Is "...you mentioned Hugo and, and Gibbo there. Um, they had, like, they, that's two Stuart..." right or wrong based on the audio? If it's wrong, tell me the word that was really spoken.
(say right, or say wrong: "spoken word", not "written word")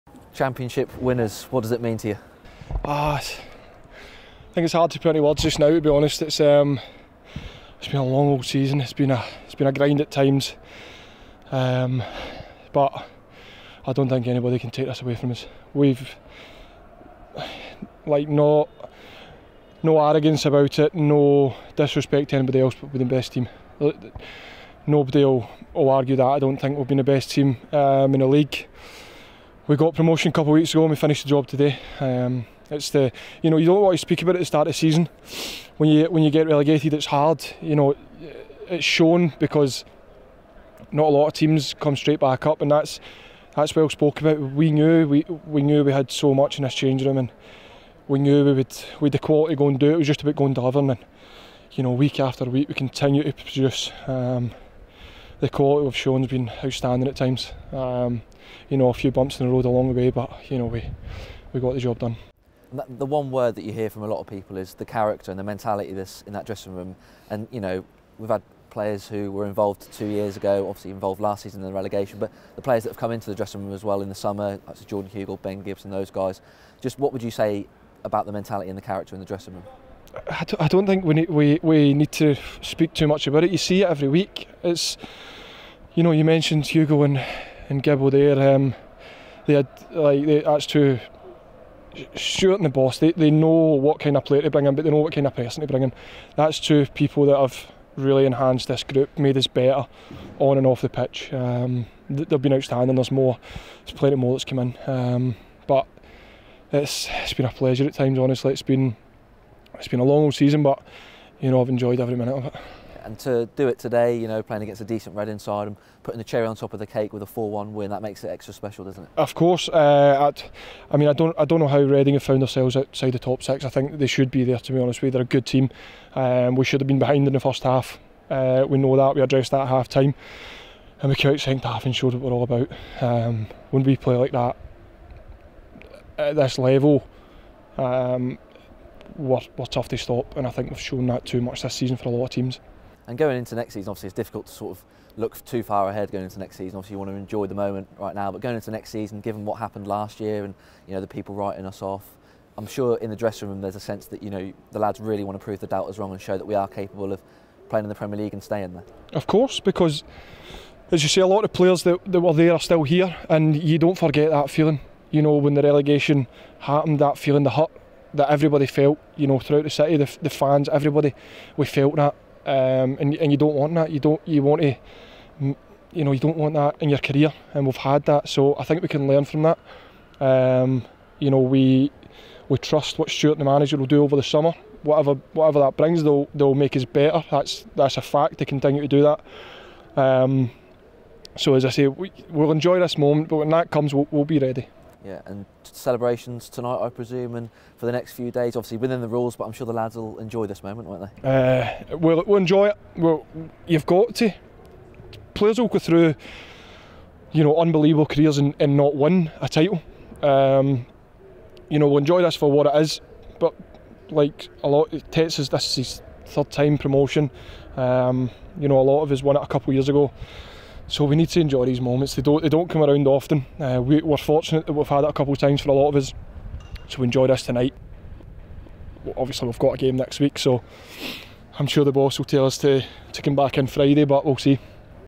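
right.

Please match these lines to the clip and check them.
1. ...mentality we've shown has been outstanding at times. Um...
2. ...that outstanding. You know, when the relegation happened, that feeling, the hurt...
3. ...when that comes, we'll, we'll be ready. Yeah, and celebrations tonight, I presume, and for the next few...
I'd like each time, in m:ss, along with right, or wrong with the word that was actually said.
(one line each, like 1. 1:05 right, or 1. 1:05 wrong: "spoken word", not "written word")
1. 0:55 wrong: "quality", not "mentality"
2. 2:44 wrong: "feeling", not "outstanding"
3. 3:13 right.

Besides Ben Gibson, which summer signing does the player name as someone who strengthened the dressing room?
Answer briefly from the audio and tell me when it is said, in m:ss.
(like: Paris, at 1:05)
Jordan Hugill, at 1:14.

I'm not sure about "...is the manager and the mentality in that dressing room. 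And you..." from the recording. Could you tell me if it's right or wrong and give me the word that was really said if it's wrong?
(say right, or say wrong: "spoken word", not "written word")
wrong: "character", not "manager".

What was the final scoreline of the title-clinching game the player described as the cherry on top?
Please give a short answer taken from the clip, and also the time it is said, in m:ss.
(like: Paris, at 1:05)
4-1, at 1:57.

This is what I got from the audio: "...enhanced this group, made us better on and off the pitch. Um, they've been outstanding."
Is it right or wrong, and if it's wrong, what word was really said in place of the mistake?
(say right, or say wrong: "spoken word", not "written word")
right.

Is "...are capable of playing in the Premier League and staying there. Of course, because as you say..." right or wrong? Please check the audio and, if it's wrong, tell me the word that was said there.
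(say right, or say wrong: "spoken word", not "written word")
right.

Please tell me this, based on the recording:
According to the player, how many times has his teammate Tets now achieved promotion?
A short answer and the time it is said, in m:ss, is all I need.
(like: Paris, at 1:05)
3, at 3:36.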